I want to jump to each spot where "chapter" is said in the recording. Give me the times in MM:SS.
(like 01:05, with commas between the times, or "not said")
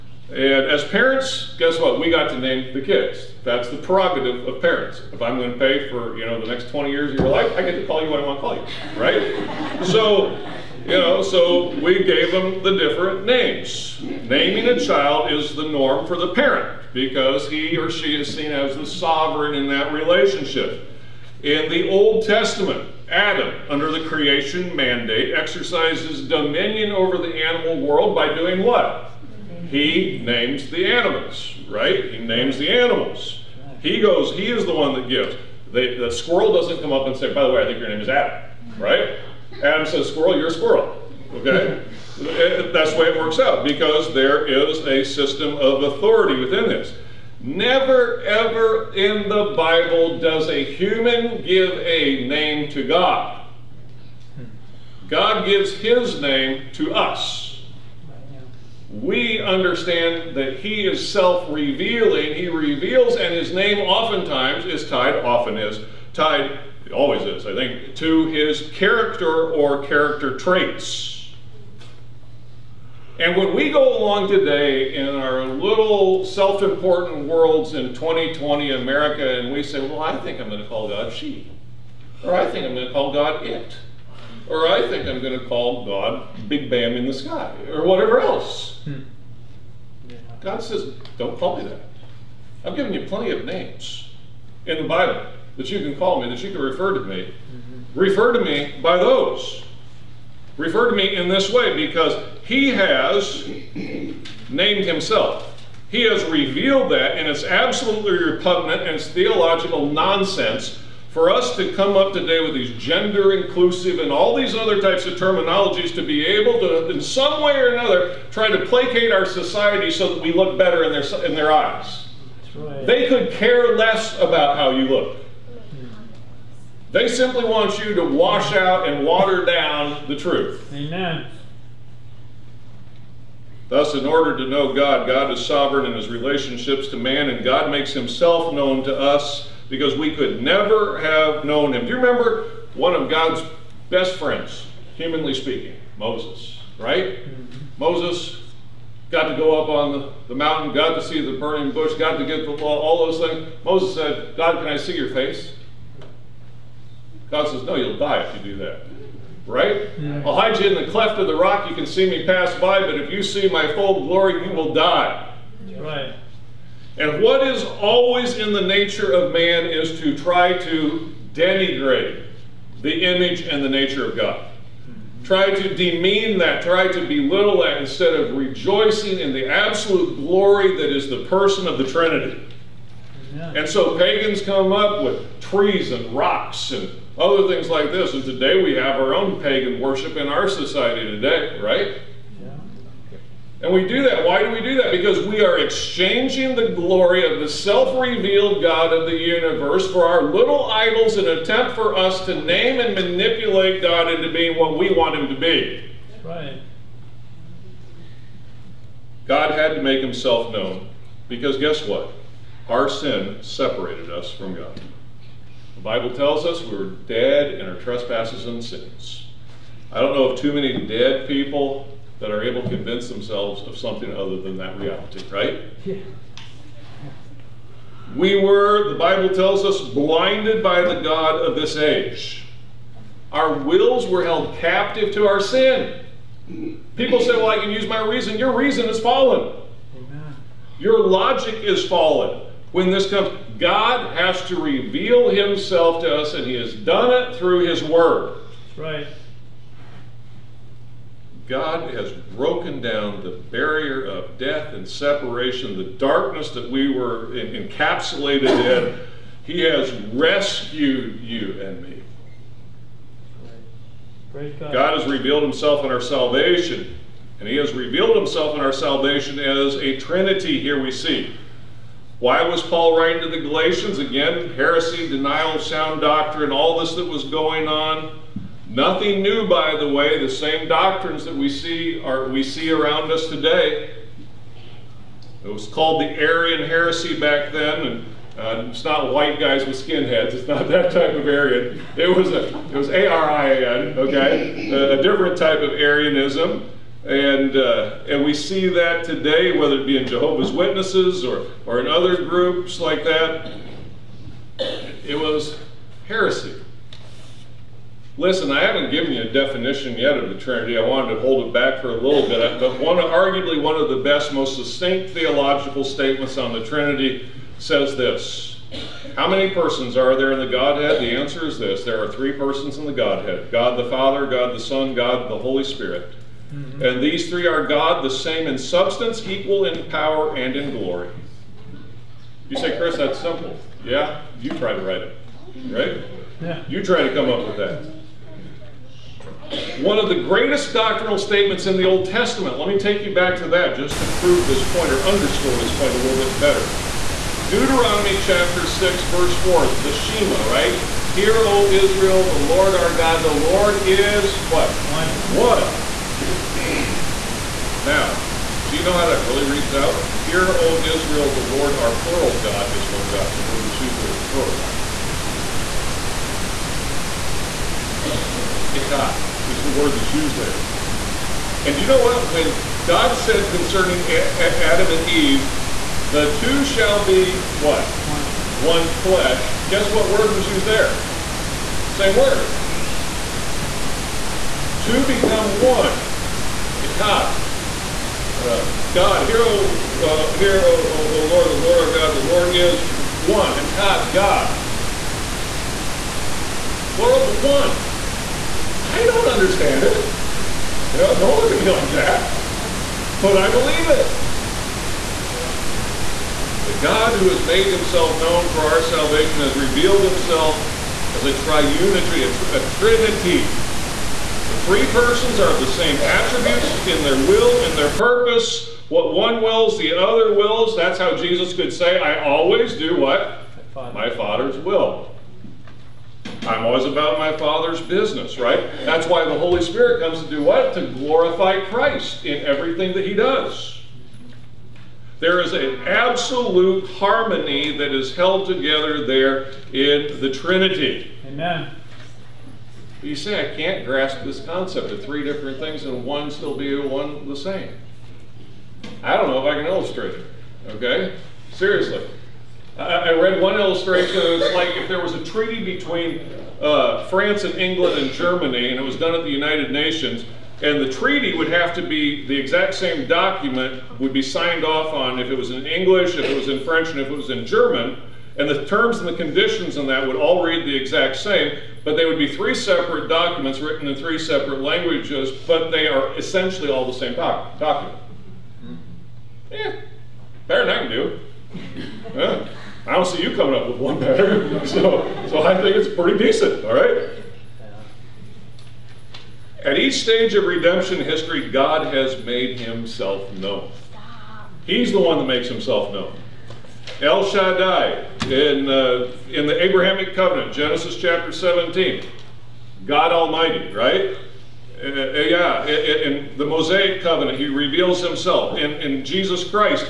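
05:48, 08:20.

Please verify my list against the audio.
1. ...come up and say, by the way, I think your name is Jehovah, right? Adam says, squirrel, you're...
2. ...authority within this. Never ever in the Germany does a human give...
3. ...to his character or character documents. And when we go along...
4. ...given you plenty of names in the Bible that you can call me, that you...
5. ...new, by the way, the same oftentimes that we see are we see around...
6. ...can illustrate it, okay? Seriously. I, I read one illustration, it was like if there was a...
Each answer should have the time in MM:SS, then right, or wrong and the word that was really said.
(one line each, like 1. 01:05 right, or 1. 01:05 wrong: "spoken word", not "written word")
1. 00:36 wrong: "Adam", not "Jehovah"
2. 00:45 wrong: "Bible", not "Germany"
3. 01:07 wrong: "traits", not "documents"
4. 01:32 right
5. 04:39 wrong: "doctrines", not "oftentimes"
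6. 07:29 right.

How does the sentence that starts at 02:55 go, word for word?
Try to demean that, try to belittle that instead of rejoicing in the absolute glory that is the person of the Trinity.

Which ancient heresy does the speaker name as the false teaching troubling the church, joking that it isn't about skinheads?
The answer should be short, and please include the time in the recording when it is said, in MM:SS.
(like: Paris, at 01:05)
Arian heresy, at 04:46.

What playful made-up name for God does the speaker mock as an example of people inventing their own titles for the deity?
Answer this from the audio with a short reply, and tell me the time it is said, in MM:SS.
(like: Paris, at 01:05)
Big Bam in the sky, at 01:26.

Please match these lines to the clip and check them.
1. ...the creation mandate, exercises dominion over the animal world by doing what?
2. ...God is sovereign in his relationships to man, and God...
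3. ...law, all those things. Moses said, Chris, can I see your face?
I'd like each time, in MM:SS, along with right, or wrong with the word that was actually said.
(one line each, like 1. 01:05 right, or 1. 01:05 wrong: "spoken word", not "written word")
1. 00:23 right
2. 02:15 right
3. 02:32 wrong: "God", not "Chris".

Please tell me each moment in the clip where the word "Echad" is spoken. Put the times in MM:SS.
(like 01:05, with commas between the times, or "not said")
06:08, 06:26, 06:33.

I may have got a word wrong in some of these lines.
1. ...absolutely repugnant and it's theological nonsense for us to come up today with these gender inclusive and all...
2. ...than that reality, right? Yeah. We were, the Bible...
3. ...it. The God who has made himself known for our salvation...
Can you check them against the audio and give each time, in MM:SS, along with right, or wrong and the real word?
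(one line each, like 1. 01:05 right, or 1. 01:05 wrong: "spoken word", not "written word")
1. 01:47 right
2. 03:44 right
3. 06:43 right.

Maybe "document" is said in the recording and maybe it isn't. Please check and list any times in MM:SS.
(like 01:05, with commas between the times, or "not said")
07:43, 07:53, 07:57.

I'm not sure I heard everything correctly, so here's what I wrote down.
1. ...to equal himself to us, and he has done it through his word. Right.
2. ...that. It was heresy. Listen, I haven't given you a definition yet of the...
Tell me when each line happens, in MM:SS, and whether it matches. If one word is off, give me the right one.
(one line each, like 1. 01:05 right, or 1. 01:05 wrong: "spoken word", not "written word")
1. 04:04 wrong: "reveal", not "equal"
2. 05:03 right.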